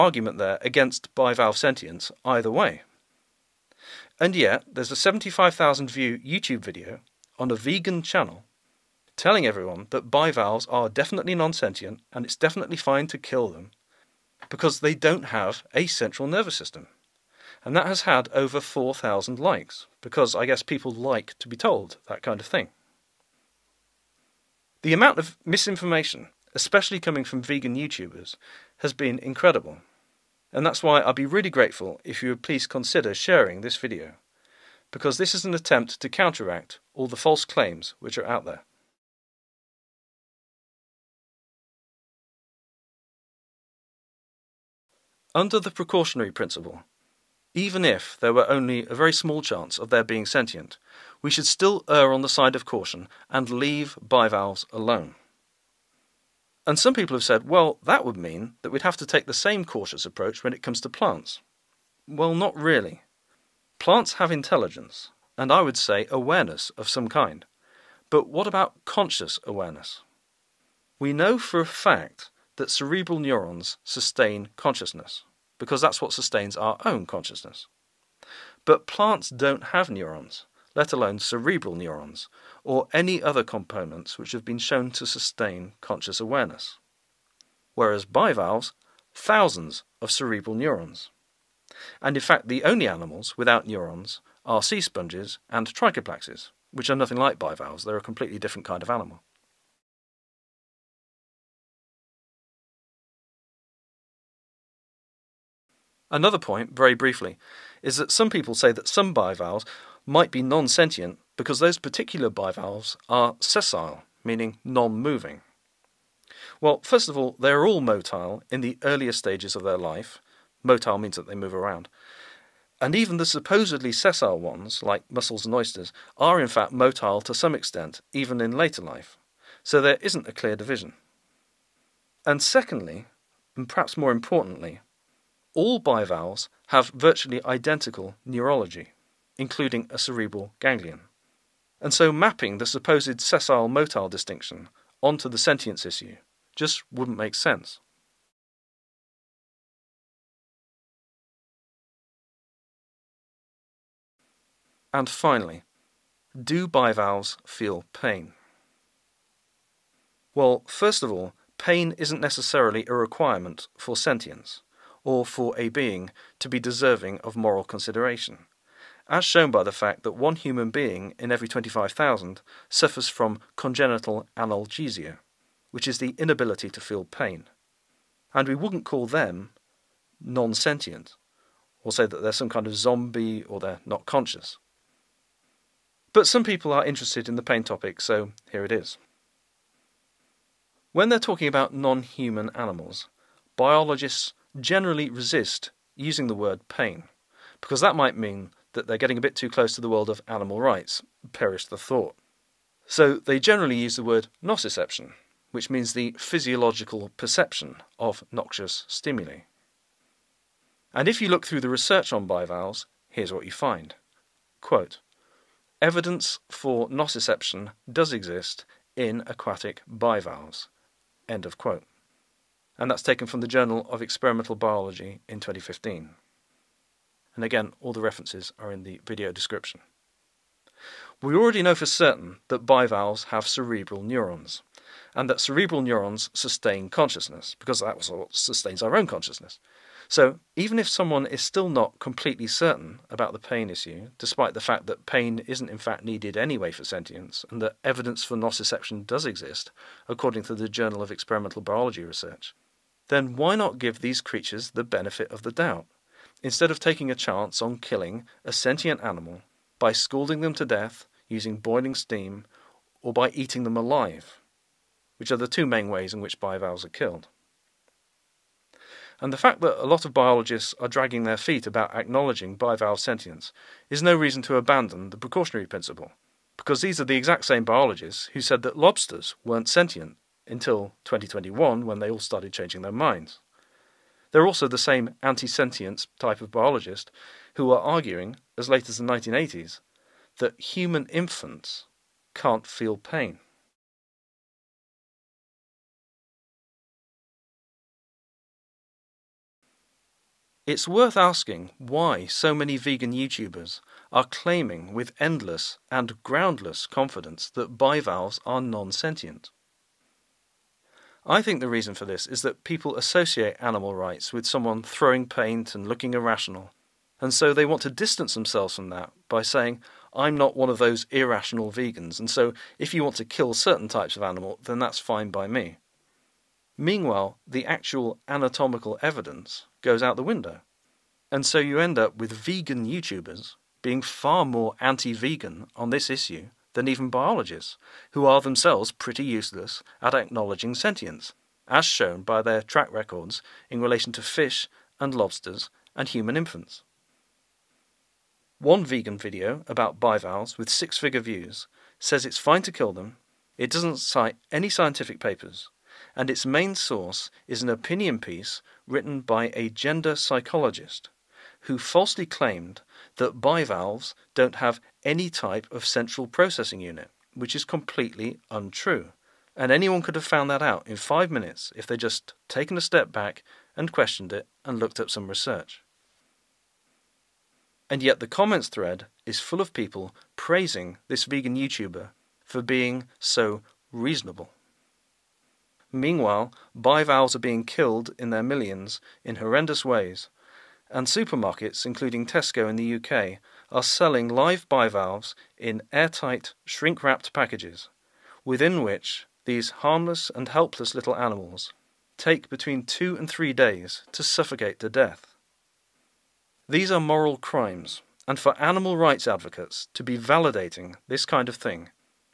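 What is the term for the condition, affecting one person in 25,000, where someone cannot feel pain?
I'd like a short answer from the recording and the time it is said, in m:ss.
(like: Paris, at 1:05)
congenital analgesia, at 2:53.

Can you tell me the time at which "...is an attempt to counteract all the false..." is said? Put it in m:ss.
0:35.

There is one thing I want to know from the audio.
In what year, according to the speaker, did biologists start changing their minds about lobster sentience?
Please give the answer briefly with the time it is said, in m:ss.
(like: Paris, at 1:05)
2021, at 4:41.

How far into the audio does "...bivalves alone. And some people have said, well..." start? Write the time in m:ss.
0:54.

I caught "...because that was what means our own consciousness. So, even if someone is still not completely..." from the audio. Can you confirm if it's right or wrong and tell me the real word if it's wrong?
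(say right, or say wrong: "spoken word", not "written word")
wrong: "sustains", not "means".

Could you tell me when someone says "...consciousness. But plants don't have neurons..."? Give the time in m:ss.
1:17.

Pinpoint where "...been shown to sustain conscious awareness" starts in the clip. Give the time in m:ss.
1:24.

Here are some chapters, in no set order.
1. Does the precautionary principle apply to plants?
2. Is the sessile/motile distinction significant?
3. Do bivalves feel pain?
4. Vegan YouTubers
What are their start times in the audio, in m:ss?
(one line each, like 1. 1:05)
1. 0:24
2. 1:25
3. 2:14
4. 4:39.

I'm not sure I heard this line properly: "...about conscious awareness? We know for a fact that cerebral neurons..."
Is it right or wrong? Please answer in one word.
right.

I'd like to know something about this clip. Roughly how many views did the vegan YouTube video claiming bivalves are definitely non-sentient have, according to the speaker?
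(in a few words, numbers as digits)
75,000.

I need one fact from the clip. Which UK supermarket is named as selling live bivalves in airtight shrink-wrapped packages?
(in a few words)
Tesco.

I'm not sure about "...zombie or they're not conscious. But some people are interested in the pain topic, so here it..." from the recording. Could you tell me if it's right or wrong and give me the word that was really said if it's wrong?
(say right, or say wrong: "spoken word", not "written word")
right.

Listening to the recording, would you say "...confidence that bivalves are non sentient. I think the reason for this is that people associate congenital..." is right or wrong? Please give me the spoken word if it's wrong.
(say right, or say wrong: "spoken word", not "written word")
wrong: "animal", not "congenital".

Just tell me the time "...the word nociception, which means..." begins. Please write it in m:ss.
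3:23.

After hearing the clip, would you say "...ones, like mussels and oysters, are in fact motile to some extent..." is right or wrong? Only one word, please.
right.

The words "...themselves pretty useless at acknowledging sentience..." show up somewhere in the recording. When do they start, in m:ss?
5:38.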